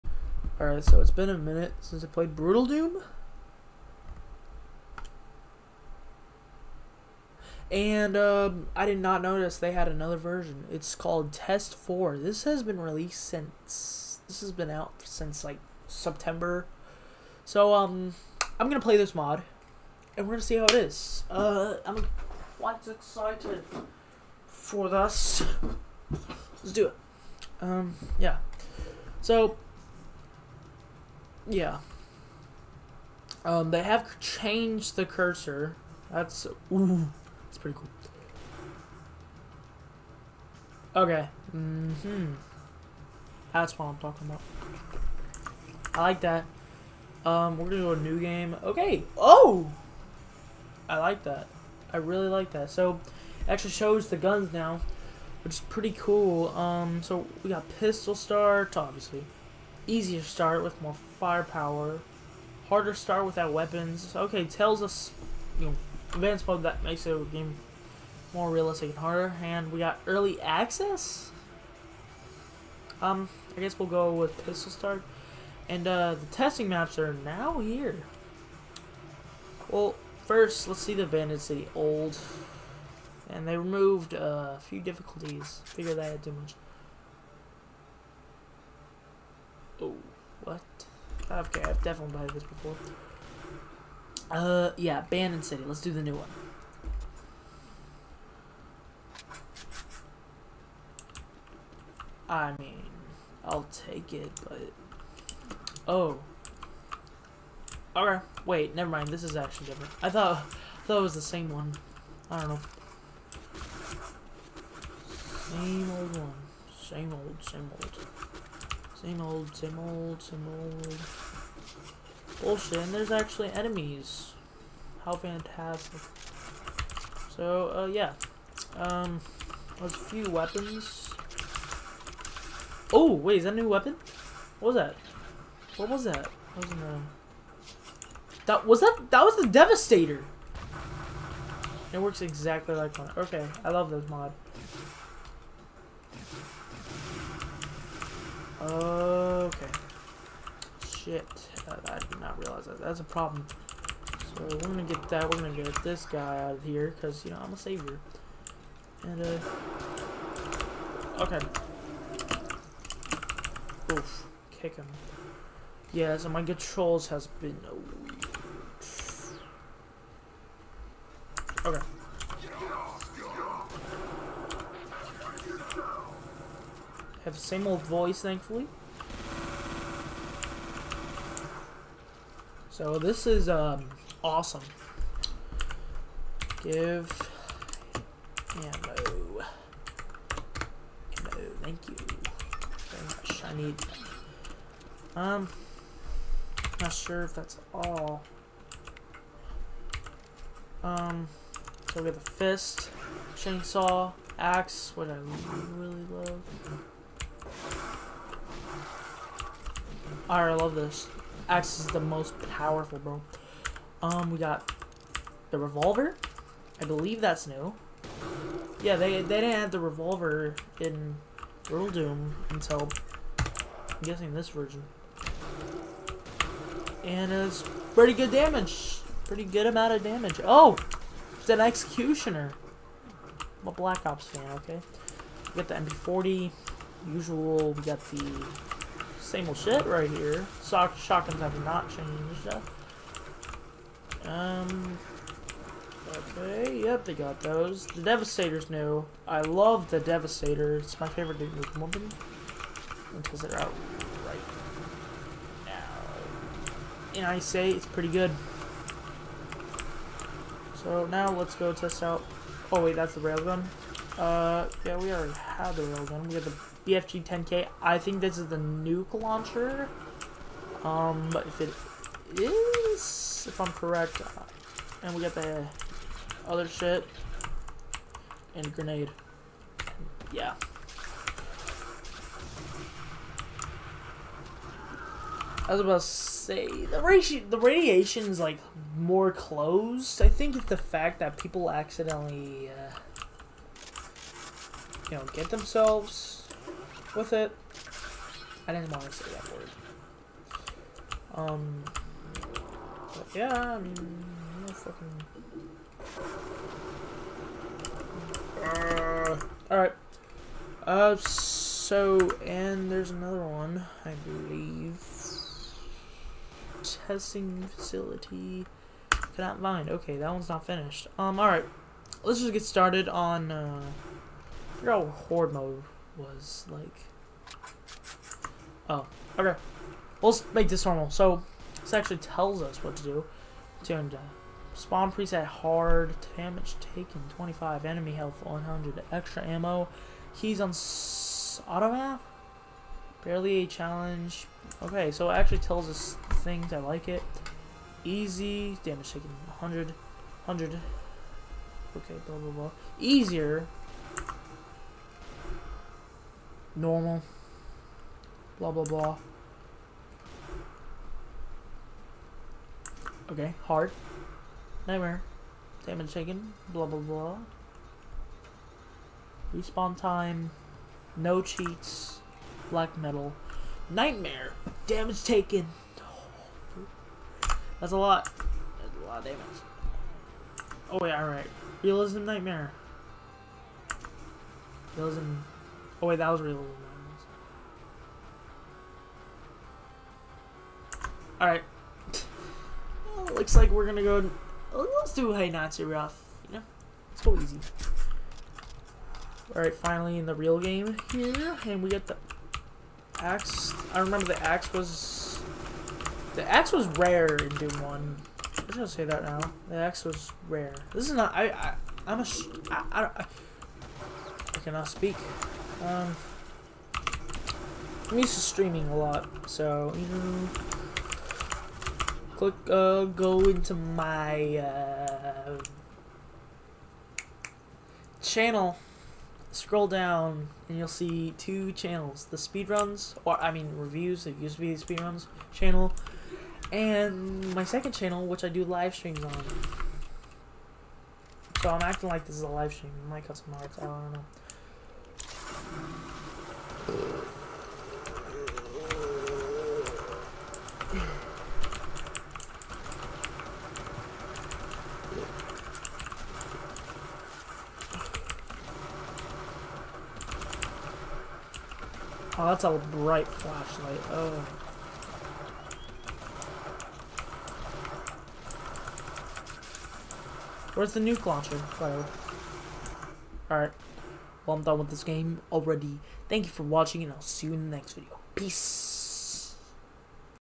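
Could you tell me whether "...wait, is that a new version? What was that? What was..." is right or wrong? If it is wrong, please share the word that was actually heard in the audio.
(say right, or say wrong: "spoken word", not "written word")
wrong: "weapon", not "version".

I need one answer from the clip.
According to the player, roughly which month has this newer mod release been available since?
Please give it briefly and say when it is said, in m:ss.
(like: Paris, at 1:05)
September, at 0:15.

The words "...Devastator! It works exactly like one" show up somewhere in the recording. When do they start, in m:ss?
2:19.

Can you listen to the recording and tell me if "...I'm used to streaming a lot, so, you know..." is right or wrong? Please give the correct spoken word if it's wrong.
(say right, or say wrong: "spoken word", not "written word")
right.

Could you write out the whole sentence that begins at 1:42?
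I mean, I'll take it, but...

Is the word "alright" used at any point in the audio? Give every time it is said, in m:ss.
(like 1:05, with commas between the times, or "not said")
0:00, 5:09, 5:21, 6:21, 6:31, 6:39, 7:51.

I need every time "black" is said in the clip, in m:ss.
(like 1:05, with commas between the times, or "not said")
3:53, 6:12.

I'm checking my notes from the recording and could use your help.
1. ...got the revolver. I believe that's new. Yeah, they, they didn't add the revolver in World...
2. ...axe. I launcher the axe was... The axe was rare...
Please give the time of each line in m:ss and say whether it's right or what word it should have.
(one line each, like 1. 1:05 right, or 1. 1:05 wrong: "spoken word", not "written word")
1. 3:34 right
2. 6:43 wrong: "remember", not "launcher".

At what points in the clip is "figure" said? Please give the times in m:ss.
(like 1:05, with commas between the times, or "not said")
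1:25, 5:24.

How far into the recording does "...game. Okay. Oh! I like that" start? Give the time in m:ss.
0:48.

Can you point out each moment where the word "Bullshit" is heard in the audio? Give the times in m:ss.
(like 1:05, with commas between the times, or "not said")
2:02.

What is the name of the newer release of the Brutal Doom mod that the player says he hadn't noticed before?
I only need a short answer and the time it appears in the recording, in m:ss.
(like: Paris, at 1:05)
Test 4, at 0:11.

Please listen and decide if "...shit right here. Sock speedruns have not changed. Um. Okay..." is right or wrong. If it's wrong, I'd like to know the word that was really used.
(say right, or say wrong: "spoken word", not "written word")
wrong: "shotguns", not "speedruns".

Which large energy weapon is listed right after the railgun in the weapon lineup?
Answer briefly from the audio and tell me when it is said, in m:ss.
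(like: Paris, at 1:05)
BFG 10K, at 4:26.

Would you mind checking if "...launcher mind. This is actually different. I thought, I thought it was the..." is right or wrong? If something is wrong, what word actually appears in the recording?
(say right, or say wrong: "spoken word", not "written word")
wrong: "never", not "launcher".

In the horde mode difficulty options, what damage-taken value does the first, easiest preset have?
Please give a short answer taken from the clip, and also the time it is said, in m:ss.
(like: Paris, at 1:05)
25, at 5:37.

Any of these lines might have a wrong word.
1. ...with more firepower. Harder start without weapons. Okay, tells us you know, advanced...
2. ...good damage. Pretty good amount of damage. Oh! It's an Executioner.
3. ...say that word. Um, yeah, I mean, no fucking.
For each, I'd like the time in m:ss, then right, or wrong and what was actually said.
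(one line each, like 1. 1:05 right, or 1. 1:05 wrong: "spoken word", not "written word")
1. 1:00 right
2. 3:48 right
3. 4:59 right.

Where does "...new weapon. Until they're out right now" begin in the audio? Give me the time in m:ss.
4:11.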